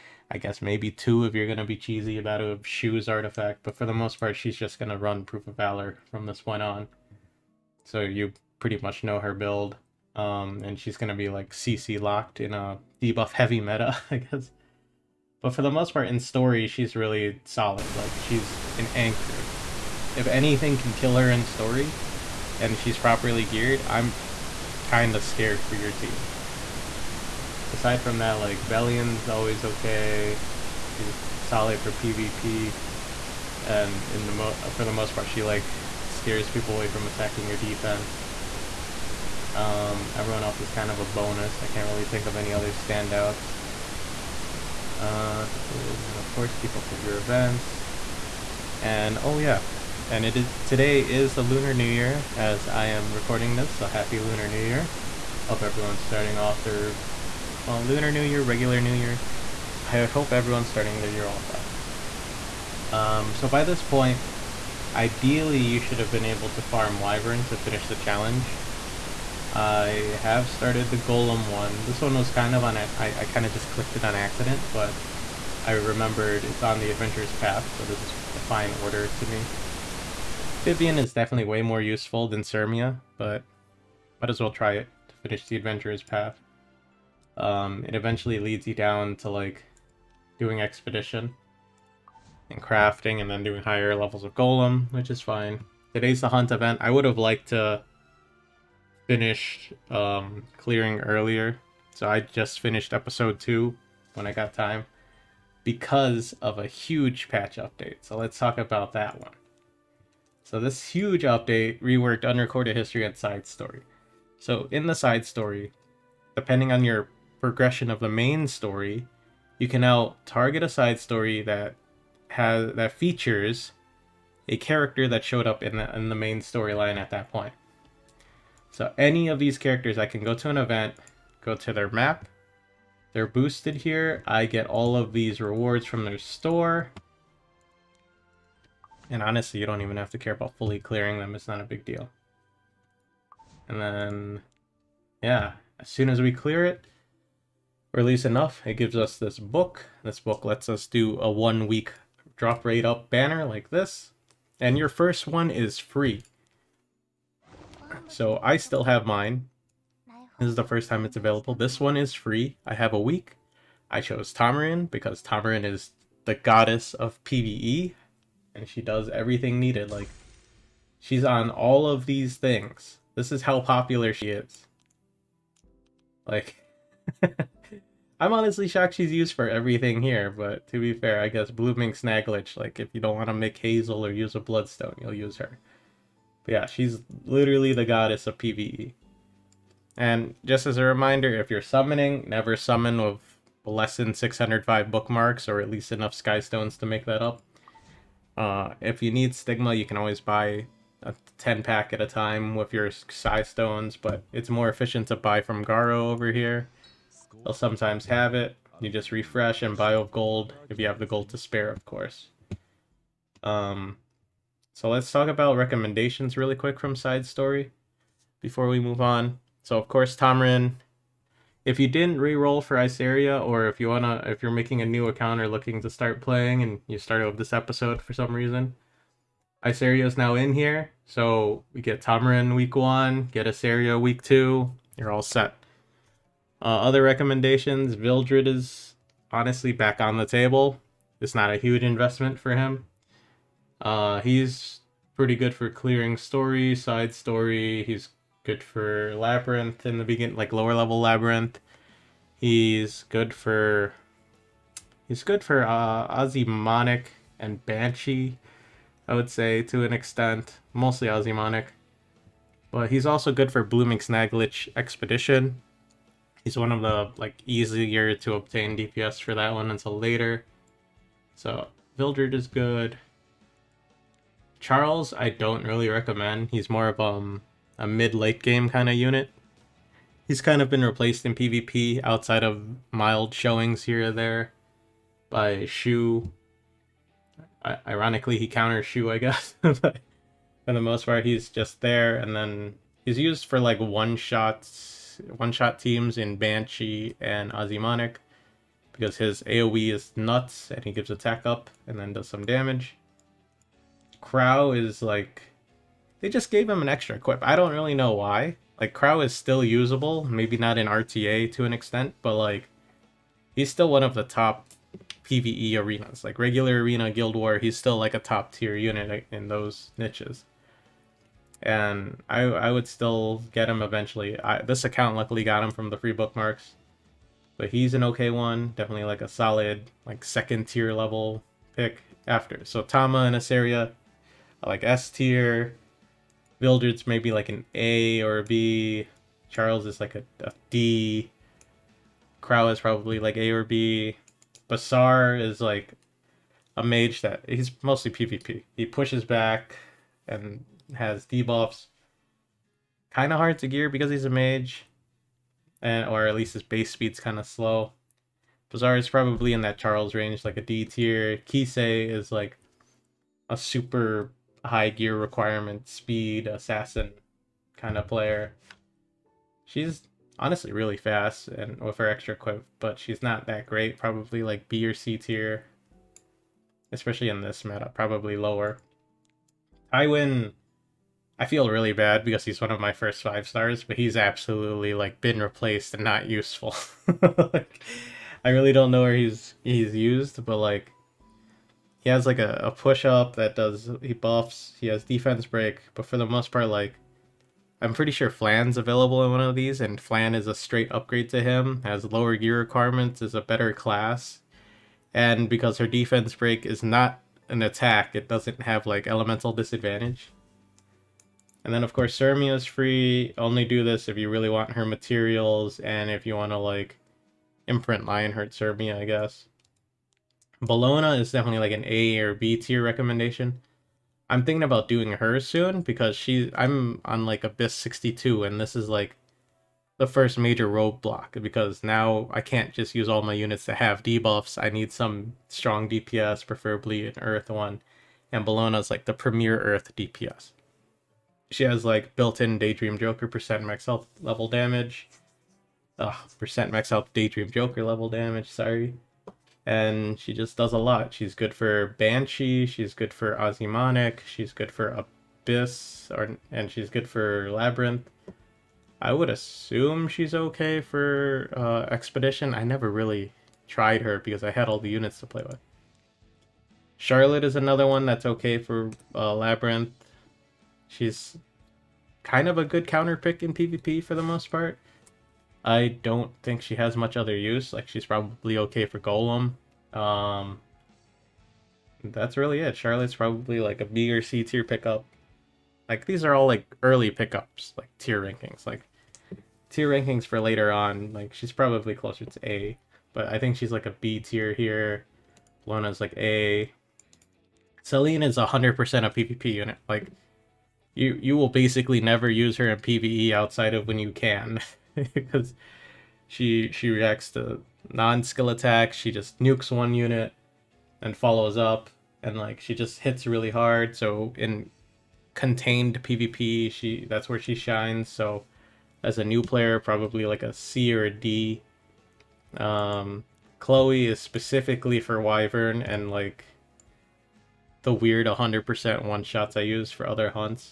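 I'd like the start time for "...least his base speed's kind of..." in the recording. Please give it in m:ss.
5:56.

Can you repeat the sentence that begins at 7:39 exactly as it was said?
I would assume she's okay for uh, Expedition.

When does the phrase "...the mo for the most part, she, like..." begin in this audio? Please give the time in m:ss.
0:34.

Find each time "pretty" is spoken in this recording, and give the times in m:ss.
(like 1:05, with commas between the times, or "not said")
0:08, 4:05, 6:37.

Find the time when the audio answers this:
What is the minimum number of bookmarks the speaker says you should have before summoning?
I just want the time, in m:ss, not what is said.
3:14.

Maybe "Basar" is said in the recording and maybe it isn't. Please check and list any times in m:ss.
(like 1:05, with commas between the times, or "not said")
5:44, 5:58.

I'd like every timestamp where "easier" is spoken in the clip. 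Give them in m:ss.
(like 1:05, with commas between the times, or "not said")
4:27.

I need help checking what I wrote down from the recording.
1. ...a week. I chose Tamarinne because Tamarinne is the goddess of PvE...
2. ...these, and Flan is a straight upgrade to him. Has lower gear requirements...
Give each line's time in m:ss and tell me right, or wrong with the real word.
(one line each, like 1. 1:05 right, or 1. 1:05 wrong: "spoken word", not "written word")
1. 2:42 right
2. 6:39 right.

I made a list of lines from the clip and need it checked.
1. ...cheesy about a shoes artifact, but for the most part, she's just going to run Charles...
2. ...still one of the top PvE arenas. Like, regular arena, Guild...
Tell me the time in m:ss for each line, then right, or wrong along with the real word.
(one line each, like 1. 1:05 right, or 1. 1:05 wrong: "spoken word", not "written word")
1. 0:01 wrong: "Proof", not "Charles"
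2. 5:13 right.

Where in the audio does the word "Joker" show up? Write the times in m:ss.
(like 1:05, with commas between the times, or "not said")
7:22, 7:27.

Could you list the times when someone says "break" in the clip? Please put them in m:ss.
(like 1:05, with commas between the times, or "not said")
6:35, 6:46.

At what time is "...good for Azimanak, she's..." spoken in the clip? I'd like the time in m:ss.
7:32.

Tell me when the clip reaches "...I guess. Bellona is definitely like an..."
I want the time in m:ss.
6:58.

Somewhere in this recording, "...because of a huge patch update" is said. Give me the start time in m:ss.
1:45.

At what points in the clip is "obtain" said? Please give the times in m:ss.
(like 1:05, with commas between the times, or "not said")
4:28.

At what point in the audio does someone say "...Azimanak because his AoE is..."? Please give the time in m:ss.
4:57.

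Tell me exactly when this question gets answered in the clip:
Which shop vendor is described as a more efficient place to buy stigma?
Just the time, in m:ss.
3:25.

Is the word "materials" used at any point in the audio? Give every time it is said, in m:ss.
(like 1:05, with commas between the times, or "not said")
6:54.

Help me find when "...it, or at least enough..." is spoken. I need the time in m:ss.
2:26.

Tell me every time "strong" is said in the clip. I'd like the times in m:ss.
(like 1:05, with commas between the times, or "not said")
7:15.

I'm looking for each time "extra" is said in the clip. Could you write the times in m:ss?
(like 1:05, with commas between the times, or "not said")
5:06, 6:12.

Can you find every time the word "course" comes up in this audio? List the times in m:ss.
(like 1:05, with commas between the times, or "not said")
0:46, 3:31, 3:39, 6:51.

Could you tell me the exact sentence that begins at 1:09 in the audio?
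I have started the Golem one.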